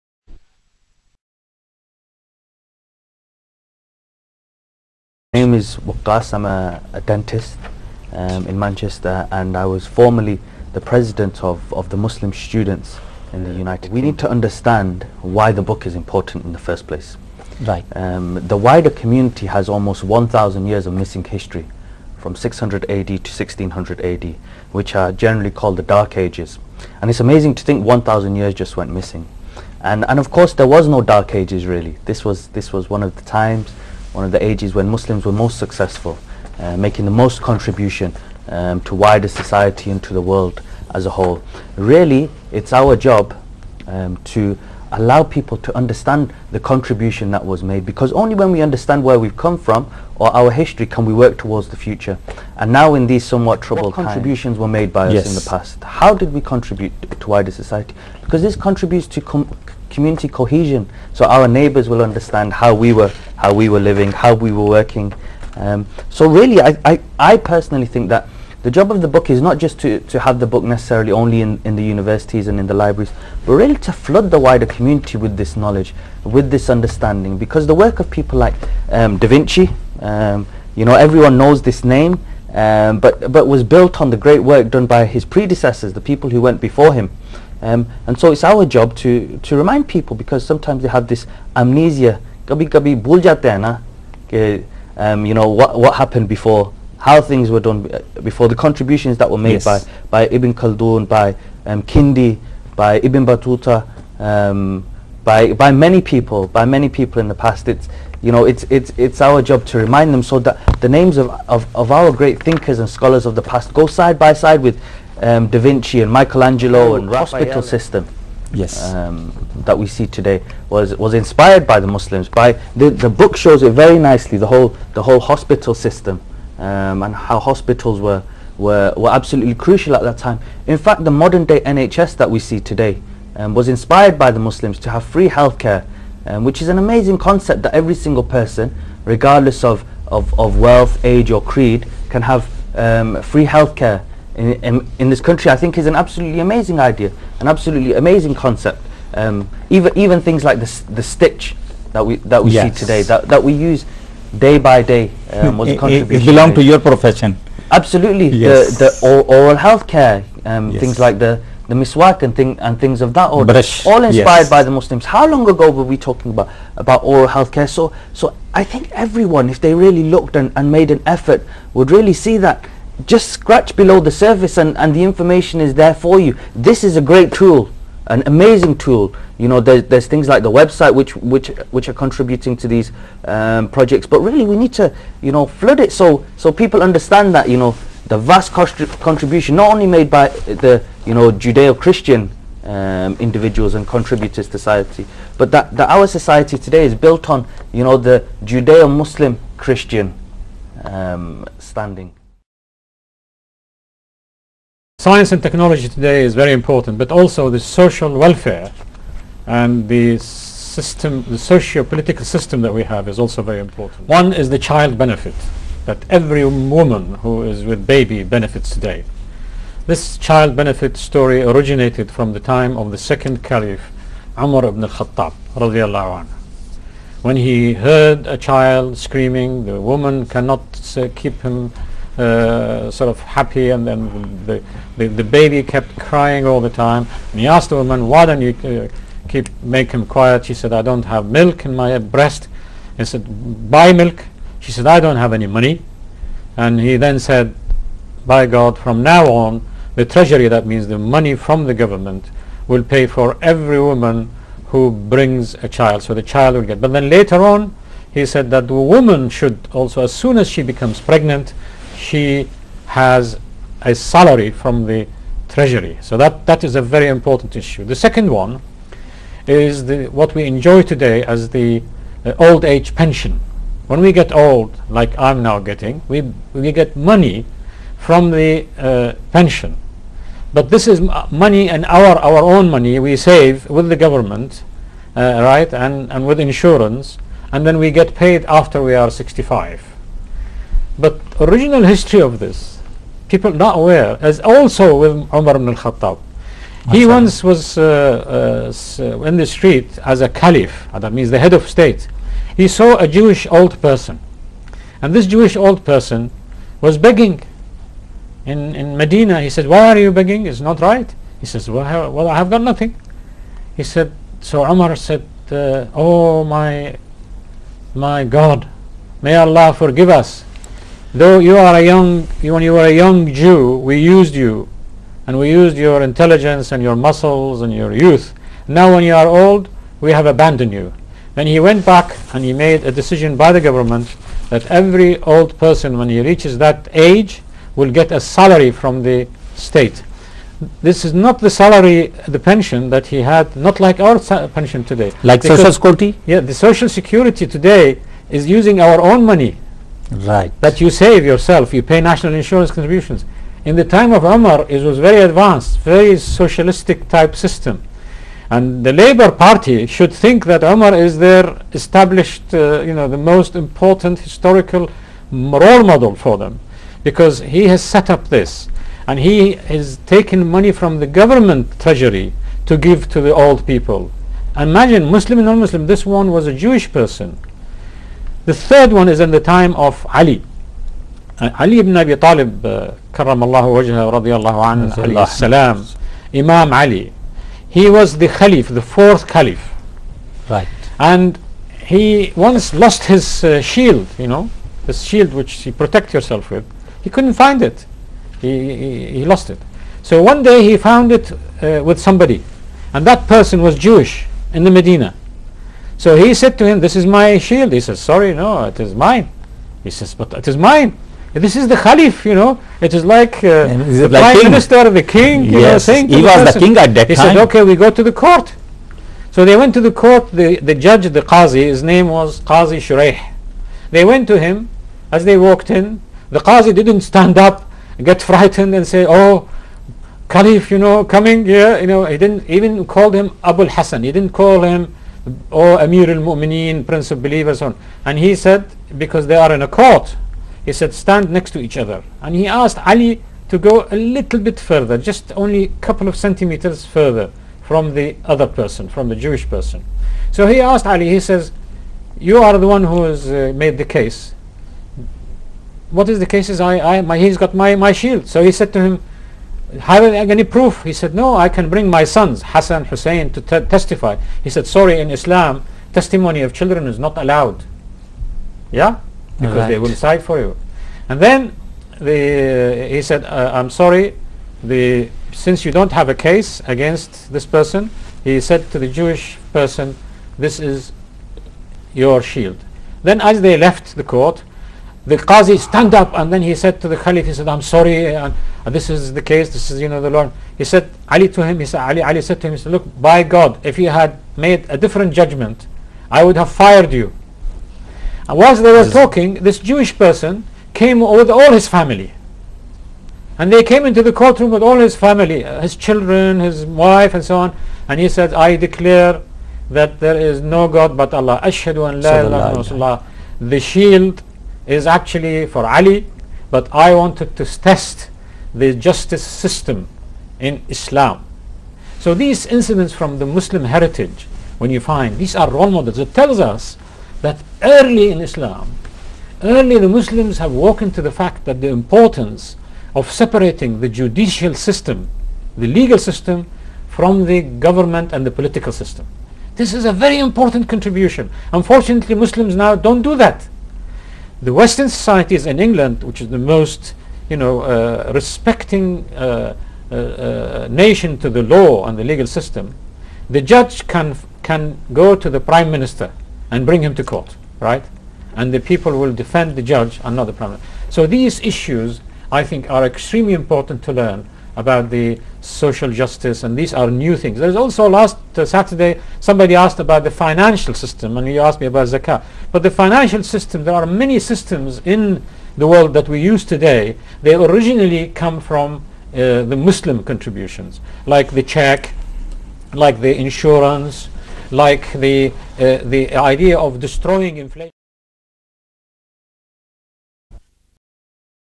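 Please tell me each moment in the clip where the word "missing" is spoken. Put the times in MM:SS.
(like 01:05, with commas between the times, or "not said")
00:20, 00:28.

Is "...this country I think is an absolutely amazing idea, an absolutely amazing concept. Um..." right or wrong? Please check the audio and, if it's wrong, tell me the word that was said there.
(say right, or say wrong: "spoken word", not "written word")
right.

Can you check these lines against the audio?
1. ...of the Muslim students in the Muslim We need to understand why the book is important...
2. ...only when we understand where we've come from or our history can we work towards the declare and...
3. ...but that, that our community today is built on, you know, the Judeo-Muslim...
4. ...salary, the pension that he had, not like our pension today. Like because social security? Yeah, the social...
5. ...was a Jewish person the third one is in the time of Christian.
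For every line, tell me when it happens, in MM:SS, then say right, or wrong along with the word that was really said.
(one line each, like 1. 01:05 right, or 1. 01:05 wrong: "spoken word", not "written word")
1. 00:11 wrong: "United", not "Muslim"
2. 00:48 wrong: "future", not "declare"
3. 03:15 wrong: "society", not "community"
4. 05:41 right
5. 06:16 wrong: "Ali", not "Christian".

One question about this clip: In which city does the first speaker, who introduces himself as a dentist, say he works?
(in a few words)
Manchester.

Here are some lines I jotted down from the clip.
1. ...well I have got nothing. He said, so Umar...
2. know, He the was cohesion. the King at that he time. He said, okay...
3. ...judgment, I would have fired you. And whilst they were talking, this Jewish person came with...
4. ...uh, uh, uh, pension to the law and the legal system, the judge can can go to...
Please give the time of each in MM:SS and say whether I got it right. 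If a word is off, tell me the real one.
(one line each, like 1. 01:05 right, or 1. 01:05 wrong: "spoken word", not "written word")
1. 05:12 right
2. 06:55 wrong: "person", not "cohesion"
3. 08:15 right
4. 09:09 wrong: "nation", not "pension".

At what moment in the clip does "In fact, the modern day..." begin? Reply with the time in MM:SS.
02:10.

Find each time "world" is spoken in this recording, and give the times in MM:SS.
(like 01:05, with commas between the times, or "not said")
00:40, 09:35.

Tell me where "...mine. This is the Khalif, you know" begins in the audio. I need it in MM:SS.
06:50.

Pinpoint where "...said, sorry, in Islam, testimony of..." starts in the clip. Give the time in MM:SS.
07:44.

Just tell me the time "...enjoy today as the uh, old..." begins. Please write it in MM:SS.
04:30.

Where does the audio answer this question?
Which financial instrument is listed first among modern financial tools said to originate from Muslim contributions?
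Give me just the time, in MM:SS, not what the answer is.
09:41.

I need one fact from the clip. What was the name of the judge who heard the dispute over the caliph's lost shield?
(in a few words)
Qazi Shuraih.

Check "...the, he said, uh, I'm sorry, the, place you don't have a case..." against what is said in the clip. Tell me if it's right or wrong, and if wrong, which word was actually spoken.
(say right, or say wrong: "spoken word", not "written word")
wrong: "since", not "place".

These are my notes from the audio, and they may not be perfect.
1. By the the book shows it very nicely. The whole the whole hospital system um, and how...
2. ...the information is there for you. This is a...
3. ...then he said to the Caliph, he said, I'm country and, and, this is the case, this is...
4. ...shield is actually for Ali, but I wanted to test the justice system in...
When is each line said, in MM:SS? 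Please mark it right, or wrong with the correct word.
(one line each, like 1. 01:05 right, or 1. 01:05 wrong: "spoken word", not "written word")
1. 02:02 right
2. 02:54 right
3. 08:06 wrong: "sorry", not "country"
4. 08:33 right.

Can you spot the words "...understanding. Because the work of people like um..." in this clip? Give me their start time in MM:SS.
01:16.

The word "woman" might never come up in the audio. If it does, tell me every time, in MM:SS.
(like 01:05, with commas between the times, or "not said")
03:36, 03:49, 03:57, 04:13, 04:18.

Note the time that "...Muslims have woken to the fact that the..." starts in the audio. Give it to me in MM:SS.
08:49.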